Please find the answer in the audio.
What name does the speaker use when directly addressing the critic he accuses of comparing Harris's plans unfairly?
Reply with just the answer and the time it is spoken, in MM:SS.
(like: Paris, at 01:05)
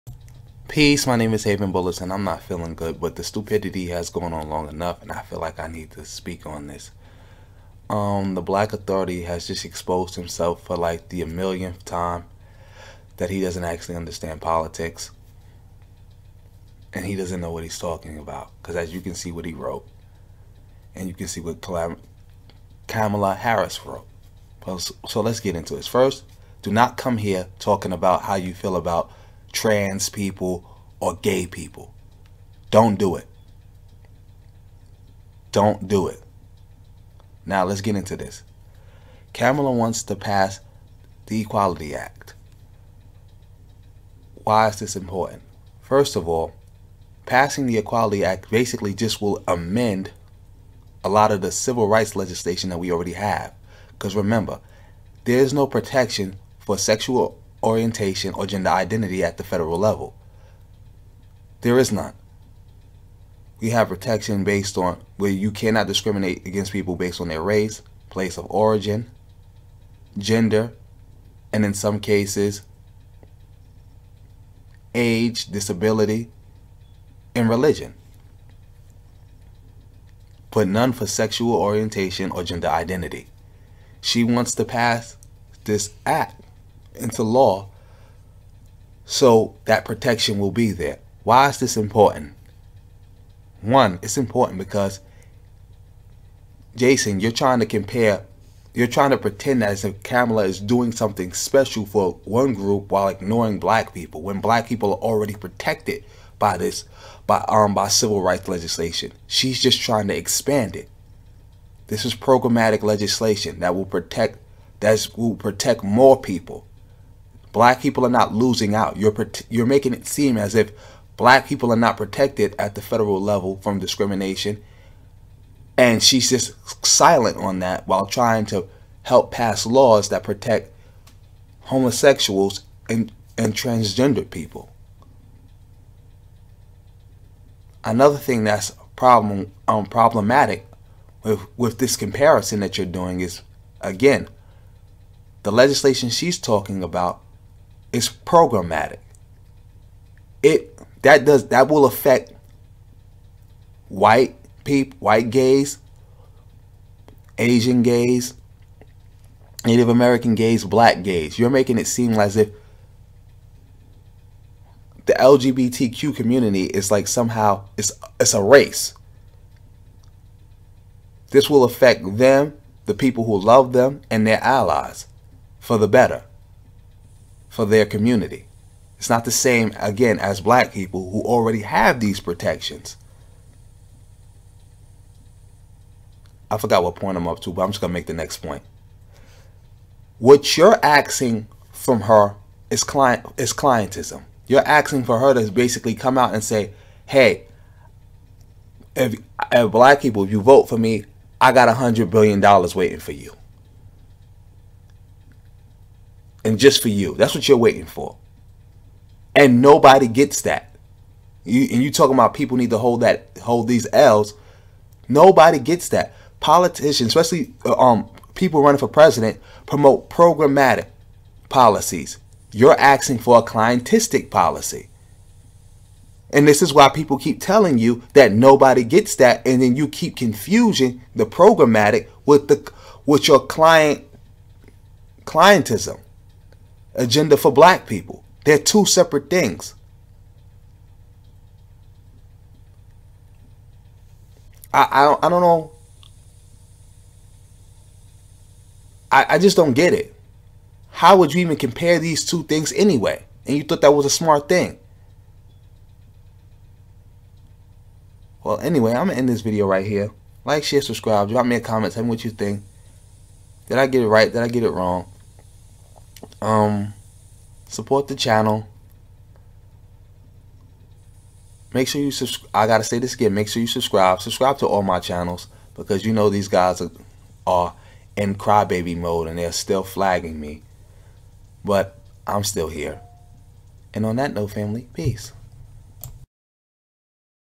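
Jason, at 01:36.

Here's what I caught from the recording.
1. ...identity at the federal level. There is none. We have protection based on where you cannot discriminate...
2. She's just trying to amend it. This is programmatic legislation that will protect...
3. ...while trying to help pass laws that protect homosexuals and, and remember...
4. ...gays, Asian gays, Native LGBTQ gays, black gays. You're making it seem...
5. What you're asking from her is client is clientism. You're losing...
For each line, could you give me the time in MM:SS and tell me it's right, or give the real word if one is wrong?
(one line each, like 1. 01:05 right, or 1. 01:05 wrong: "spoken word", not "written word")
1. 00:58 right
2. 01:49 wrong: "expand", not "amend"
3. 02:07 wrong: "transgender", not "remember"
4. 02:35 wrong: "American", not "LGBTQ"
5. 03:10 wrong: "asking", not "losing".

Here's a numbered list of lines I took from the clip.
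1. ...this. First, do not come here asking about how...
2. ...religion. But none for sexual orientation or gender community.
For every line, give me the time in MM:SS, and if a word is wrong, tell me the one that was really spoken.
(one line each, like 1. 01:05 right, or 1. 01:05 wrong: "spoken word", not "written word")
1. 00:25 wrong: "talking", not "asking"
2. 01:17 wrong: "identity", not "community".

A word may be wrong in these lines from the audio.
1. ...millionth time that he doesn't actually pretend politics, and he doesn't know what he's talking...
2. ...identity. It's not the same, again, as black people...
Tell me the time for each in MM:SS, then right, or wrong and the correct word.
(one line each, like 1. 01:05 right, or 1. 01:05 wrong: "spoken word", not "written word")
1. 00:11 wrong: "understand", not "pretend"
2. 02:57 wrong: "community", not "identity".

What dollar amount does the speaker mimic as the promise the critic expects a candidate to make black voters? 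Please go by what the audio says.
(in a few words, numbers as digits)
$100 billion.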